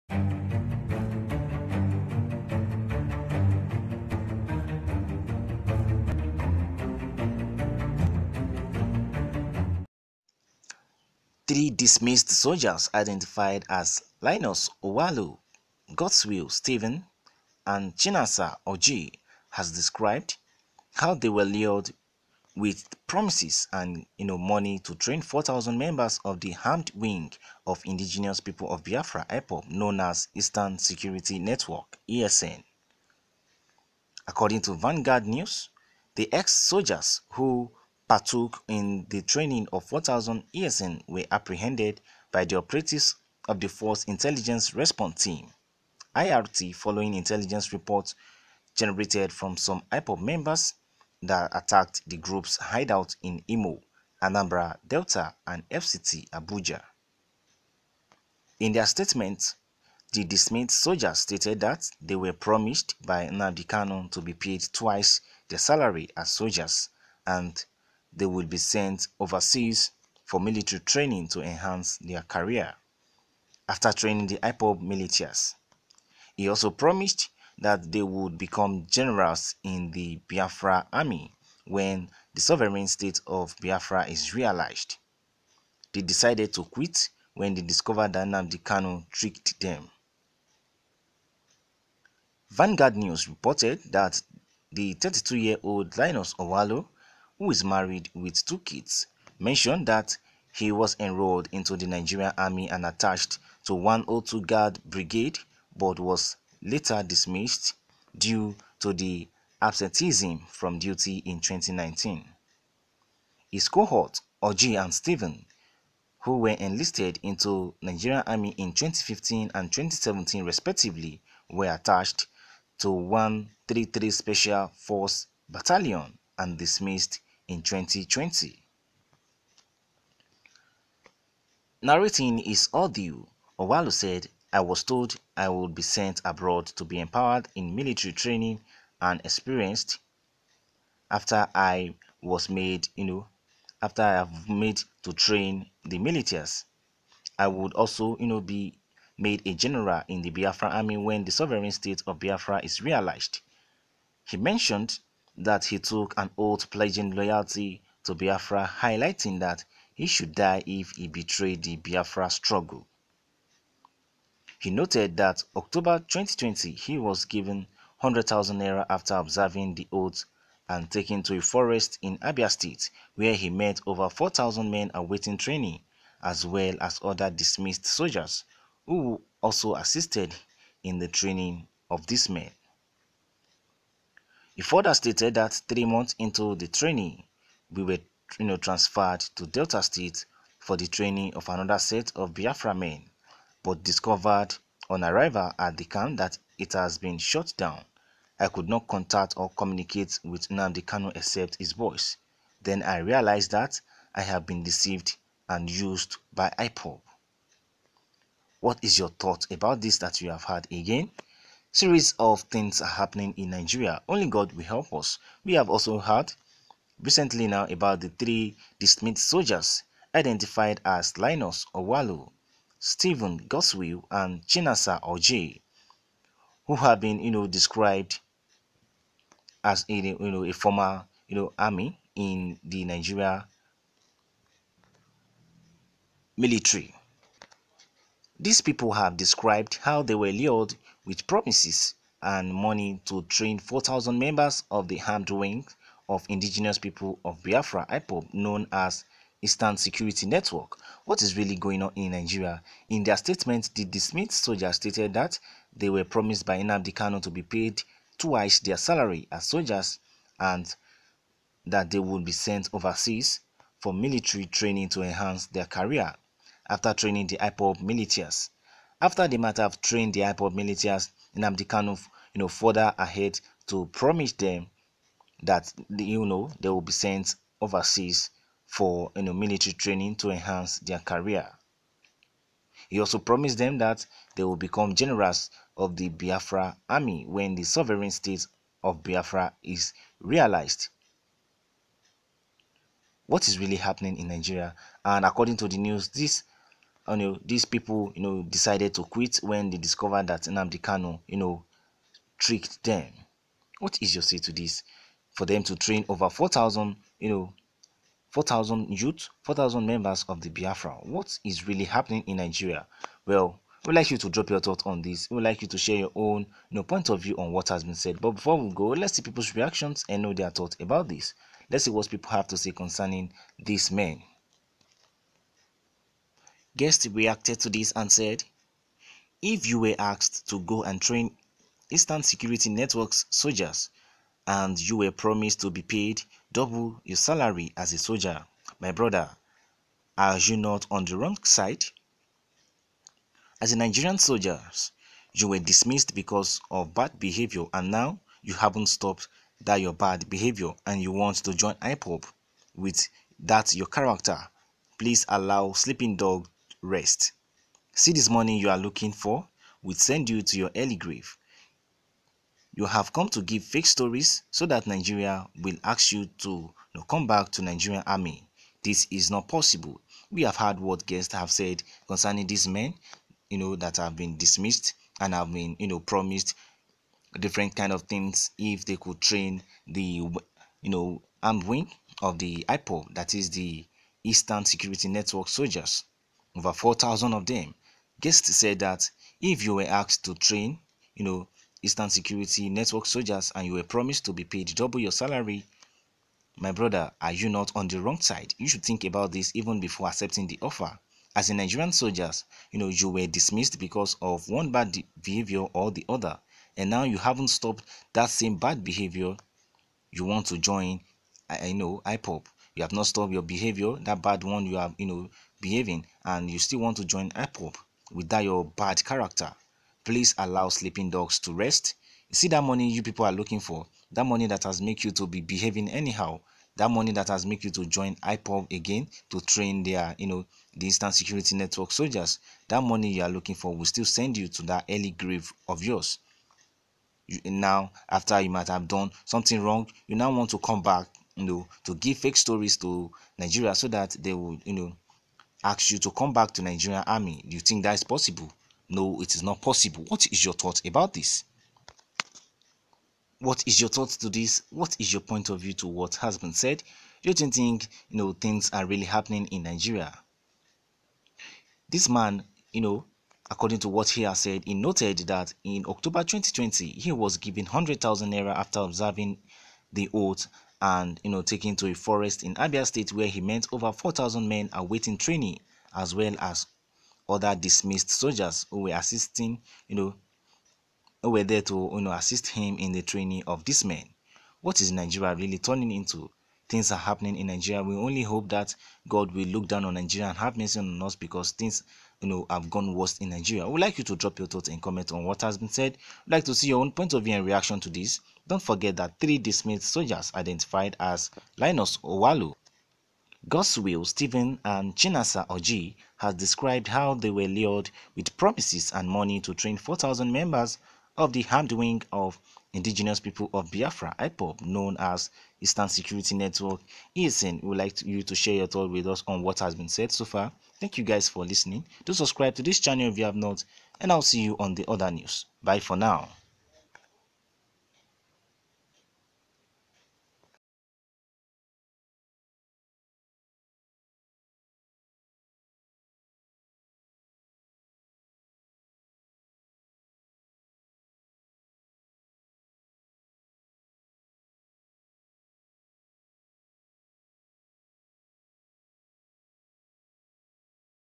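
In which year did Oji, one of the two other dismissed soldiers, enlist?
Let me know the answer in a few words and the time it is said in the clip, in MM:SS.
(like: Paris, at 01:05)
2015, at 01:58.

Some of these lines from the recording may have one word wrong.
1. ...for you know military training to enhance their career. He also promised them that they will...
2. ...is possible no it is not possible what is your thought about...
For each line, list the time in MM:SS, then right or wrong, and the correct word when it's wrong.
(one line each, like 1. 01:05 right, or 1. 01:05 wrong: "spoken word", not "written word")
1. 04:38 right
2. 07:27 right.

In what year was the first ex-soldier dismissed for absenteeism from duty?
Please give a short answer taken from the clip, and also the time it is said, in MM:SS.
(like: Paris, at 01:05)
2019, at 01:51.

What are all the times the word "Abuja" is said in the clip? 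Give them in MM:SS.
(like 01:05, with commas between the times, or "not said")
00:56.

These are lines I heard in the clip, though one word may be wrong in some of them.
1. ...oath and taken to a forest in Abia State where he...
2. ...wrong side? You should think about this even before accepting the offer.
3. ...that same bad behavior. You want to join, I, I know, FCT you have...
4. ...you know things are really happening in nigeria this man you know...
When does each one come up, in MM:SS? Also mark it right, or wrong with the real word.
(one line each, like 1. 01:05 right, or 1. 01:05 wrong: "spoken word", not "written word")
1. 02:49 right
2. 06:37 right
3. 06:48 wrong: "IPOB", not "FCT"
4. 07:38 right.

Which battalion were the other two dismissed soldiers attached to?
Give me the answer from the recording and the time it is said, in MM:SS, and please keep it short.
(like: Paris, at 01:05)
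133 Special Force Battalion, at 02:02.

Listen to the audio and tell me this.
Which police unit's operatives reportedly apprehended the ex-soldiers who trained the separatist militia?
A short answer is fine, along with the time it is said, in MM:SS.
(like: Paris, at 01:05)
Force Intelligence Response Team, at 00:43.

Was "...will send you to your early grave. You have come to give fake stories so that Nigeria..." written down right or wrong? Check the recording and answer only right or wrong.
right.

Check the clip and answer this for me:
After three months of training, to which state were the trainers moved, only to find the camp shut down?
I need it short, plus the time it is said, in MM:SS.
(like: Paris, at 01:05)
Delta State, at 03:09.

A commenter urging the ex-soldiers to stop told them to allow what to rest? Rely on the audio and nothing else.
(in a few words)
Sleeping Dog.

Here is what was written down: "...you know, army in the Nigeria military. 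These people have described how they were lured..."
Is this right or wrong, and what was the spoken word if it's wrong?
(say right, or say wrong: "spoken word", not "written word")
right.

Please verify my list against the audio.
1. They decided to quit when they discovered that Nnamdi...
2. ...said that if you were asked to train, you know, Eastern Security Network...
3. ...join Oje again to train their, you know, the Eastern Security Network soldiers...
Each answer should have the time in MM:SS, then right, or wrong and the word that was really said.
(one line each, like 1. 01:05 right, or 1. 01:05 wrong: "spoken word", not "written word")
1. 01:25 right
2. 06:28 right
3. 07:07 wrong: "IPOB", not "Oje".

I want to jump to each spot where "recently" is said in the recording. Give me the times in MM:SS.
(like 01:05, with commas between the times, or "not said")
03:37.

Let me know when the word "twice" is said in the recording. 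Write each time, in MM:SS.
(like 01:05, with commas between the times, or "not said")
01:04, 04:18.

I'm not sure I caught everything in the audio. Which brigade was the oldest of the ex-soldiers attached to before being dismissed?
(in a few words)
102 Guard Brigade.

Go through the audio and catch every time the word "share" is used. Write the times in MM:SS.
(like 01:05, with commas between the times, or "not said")
05:15, 08:38.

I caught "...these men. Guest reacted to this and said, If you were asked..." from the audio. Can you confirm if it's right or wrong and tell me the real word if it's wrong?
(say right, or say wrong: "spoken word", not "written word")
right.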